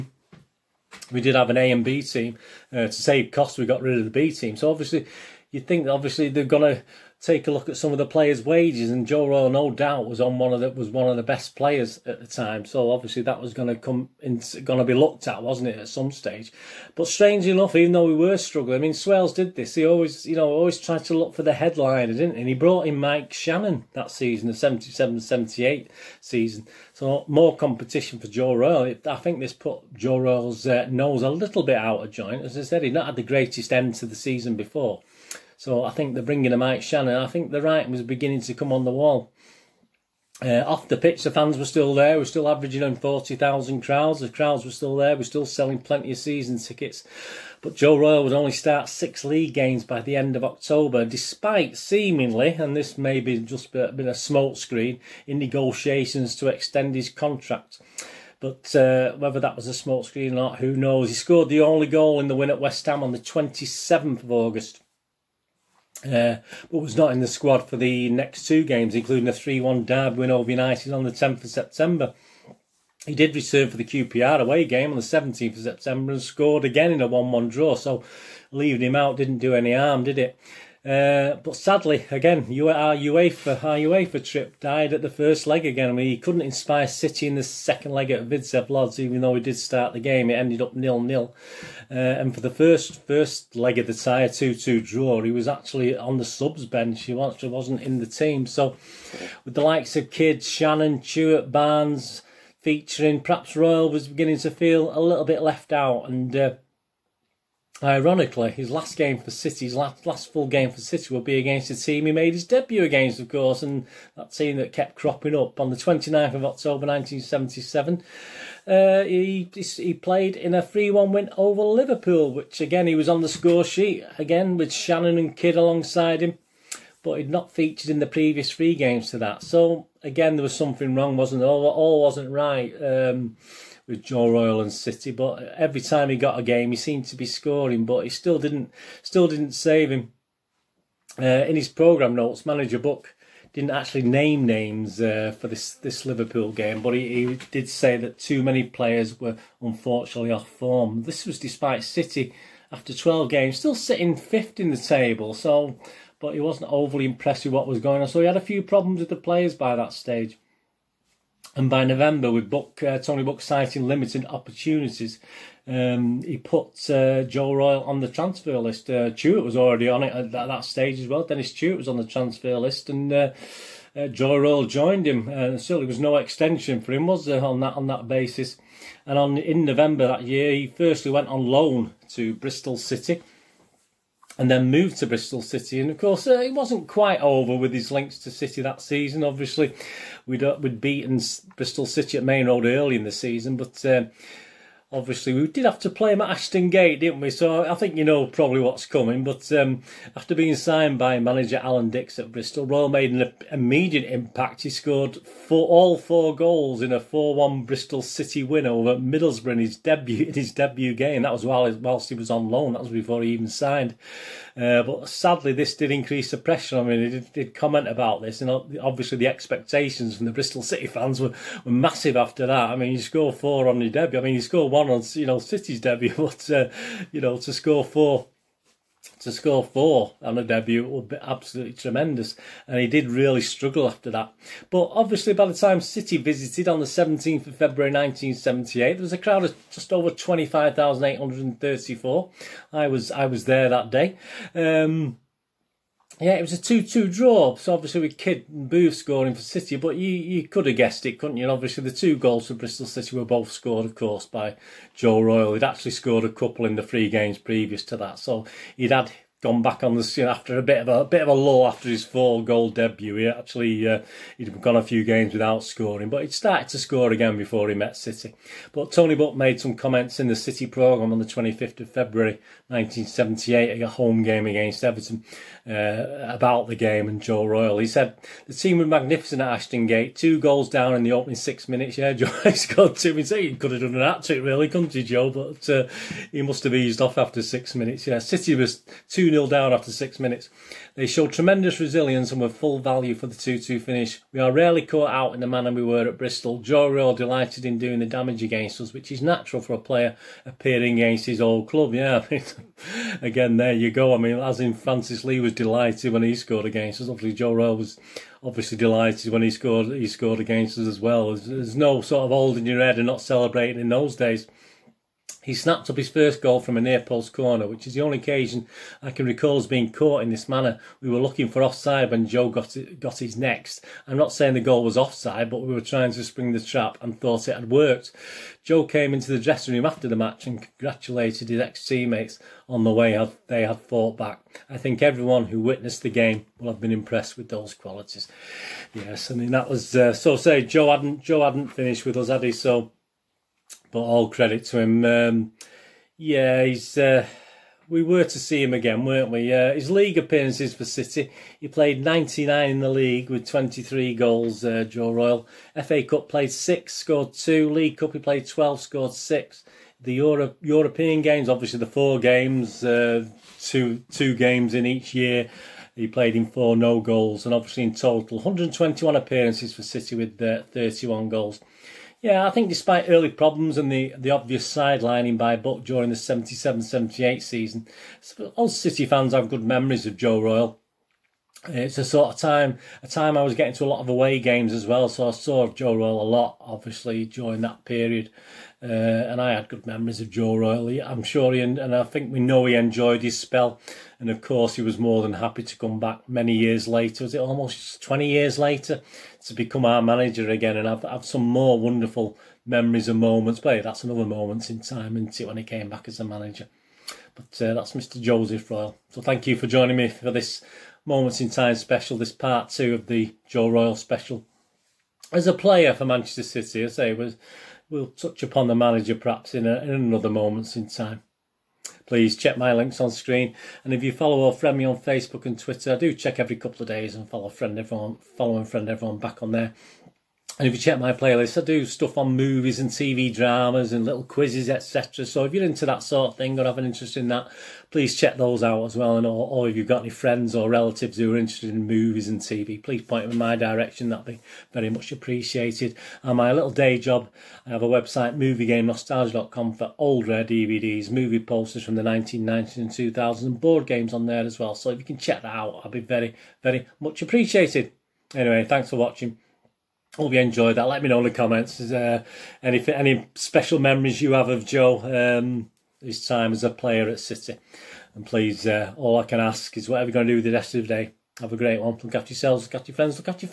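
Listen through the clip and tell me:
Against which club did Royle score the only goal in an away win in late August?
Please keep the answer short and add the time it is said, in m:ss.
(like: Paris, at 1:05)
West Ham, at 1:02.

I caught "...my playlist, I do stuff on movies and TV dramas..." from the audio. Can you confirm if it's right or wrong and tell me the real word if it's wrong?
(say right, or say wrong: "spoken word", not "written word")
right.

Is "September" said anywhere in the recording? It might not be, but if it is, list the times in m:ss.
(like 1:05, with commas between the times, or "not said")
1:11, 1:15.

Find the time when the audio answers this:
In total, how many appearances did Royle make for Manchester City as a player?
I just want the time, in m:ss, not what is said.
6:08.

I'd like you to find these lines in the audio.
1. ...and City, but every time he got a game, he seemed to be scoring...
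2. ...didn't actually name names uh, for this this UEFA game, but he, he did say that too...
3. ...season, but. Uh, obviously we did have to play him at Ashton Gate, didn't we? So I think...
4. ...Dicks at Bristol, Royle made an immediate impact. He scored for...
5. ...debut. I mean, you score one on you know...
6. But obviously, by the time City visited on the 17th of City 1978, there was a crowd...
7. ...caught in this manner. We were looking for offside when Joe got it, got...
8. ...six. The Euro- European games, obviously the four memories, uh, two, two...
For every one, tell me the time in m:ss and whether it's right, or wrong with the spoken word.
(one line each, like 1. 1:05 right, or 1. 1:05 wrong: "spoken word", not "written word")
1. 2:14 right
2. 2:23 wrong: "Liverpool", not "UEFA"
3. 3:13 right
4. 3:21 right
5. 3:43 right
6. 3:54 wrong: "February", not "City"
7. 5:19 right
8. 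5:59 wrong: "games", not "memories".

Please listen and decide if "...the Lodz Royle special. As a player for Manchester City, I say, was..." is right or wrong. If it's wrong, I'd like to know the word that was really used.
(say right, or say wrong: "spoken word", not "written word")
wrong: "Joe", not "Lodz".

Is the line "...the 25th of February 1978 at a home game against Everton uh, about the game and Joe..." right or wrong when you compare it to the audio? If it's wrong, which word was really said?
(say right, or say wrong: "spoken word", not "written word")
right.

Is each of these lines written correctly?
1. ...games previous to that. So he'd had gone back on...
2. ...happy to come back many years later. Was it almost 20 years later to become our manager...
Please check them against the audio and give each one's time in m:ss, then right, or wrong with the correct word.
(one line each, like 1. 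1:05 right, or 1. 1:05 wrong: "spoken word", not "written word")
1. 4:17 right
2. 6:35 right.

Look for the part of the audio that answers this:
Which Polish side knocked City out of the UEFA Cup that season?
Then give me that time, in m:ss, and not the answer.
1:28.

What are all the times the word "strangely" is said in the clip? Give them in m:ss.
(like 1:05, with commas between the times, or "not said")
0:17.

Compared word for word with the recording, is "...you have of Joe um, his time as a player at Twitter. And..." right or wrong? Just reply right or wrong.
wrong.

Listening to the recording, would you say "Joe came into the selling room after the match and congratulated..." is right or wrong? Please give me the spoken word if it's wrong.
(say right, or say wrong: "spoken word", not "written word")
wrong: "dressing", not "selling".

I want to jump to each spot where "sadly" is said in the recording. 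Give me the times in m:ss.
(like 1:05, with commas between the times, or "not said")
1:21, 3:35.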